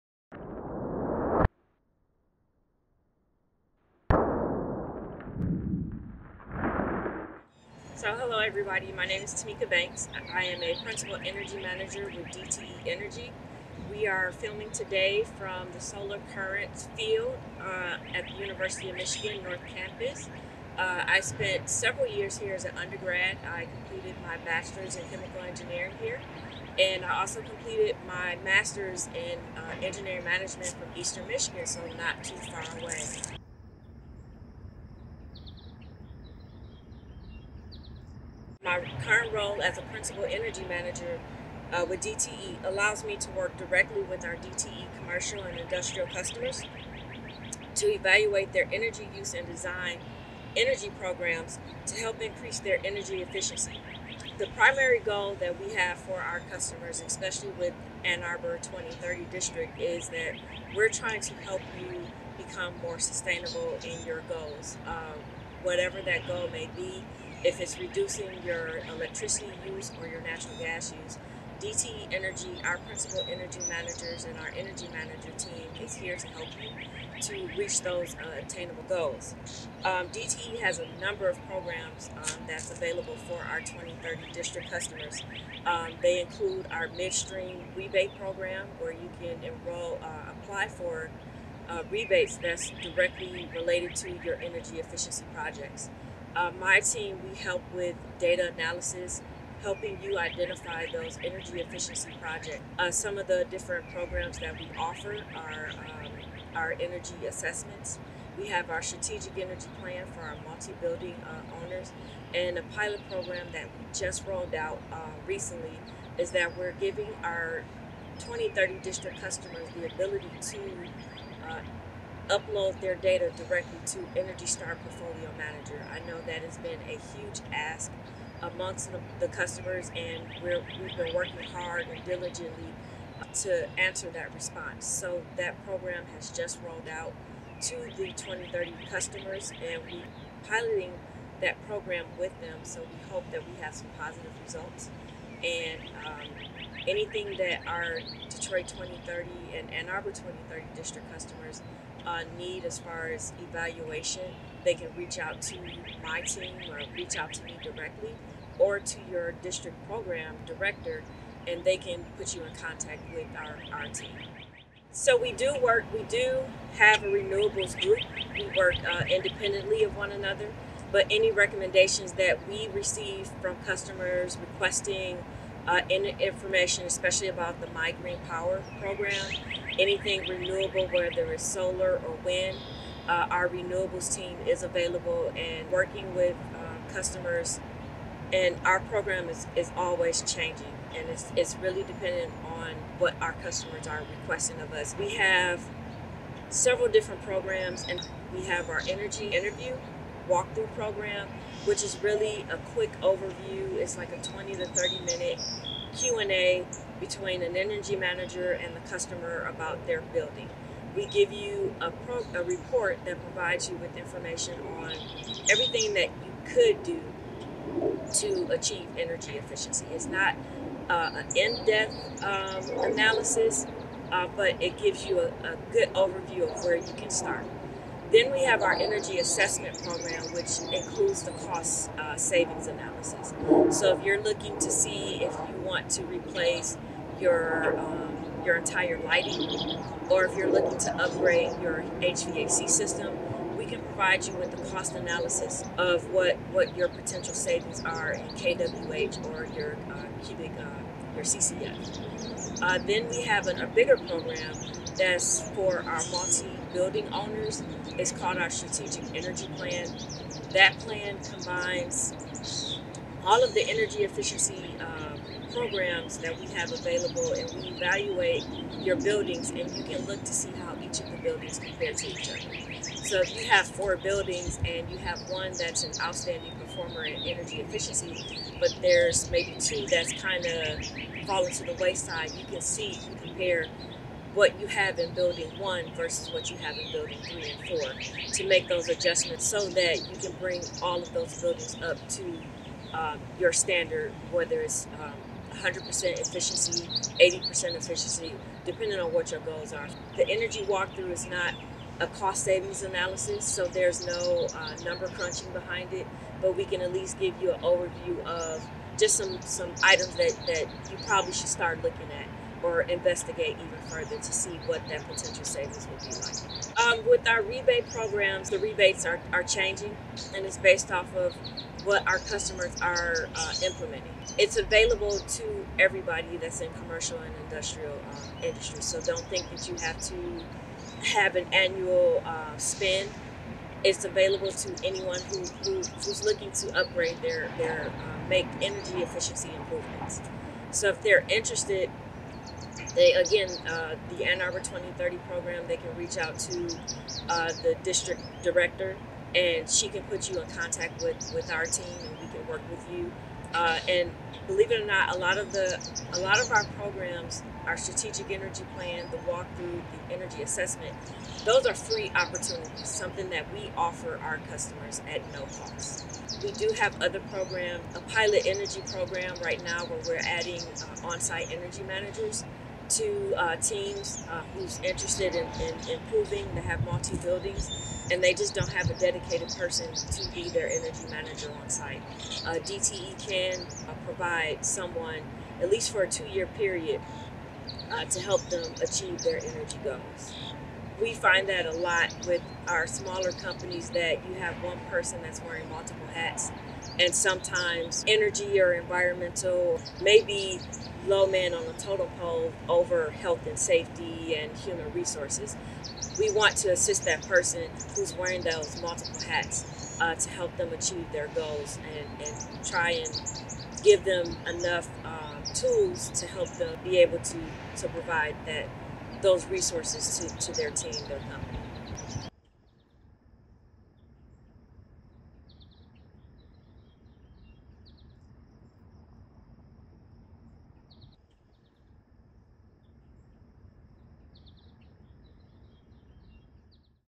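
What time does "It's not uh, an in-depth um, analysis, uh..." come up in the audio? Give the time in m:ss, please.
3:39.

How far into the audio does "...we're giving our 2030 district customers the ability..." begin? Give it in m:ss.
1:56.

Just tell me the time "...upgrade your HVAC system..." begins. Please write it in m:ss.
4:00.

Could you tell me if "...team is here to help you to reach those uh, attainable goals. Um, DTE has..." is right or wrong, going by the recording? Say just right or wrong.
right.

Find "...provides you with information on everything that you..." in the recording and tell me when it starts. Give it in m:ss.
3:33.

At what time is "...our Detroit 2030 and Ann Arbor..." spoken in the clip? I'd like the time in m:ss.
2:27.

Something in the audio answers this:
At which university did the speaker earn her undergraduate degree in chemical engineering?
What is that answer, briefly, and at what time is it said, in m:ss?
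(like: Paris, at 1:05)
University of Michigan, at 0:18.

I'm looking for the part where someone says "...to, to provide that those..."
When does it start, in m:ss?
6:57.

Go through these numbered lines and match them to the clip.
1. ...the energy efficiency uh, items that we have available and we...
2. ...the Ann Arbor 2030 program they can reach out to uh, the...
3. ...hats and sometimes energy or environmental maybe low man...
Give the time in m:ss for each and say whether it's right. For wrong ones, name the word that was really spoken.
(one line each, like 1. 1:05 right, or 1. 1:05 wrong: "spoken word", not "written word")
1. 4:23 wrong: "programs", not "items"
2. 5:44 right
3. 6:36 right.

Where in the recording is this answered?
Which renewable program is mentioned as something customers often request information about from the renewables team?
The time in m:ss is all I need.
2:57.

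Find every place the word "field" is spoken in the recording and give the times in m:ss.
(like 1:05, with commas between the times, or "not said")
0:16.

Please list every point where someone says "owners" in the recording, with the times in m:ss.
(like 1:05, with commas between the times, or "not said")
1:51, 4:17.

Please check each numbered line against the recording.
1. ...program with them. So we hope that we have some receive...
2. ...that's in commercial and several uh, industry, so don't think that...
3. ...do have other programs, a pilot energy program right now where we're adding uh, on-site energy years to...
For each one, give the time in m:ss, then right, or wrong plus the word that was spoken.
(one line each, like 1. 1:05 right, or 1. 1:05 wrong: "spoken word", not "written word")
1. 2:21 wrong: "positive", not "receive"
2. 5:26 wrong: "industrial", not "several"
3. 6:06 wrong: "managers", not "years".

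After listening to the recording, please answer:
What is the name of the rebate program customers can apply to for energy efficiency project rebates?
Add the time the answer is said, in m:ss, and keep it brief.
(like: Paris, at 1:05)
Midstream rebate program, at 1:26.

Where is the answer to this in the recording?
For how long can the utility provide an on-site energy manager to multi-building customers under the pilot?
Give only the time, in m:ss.
6:26.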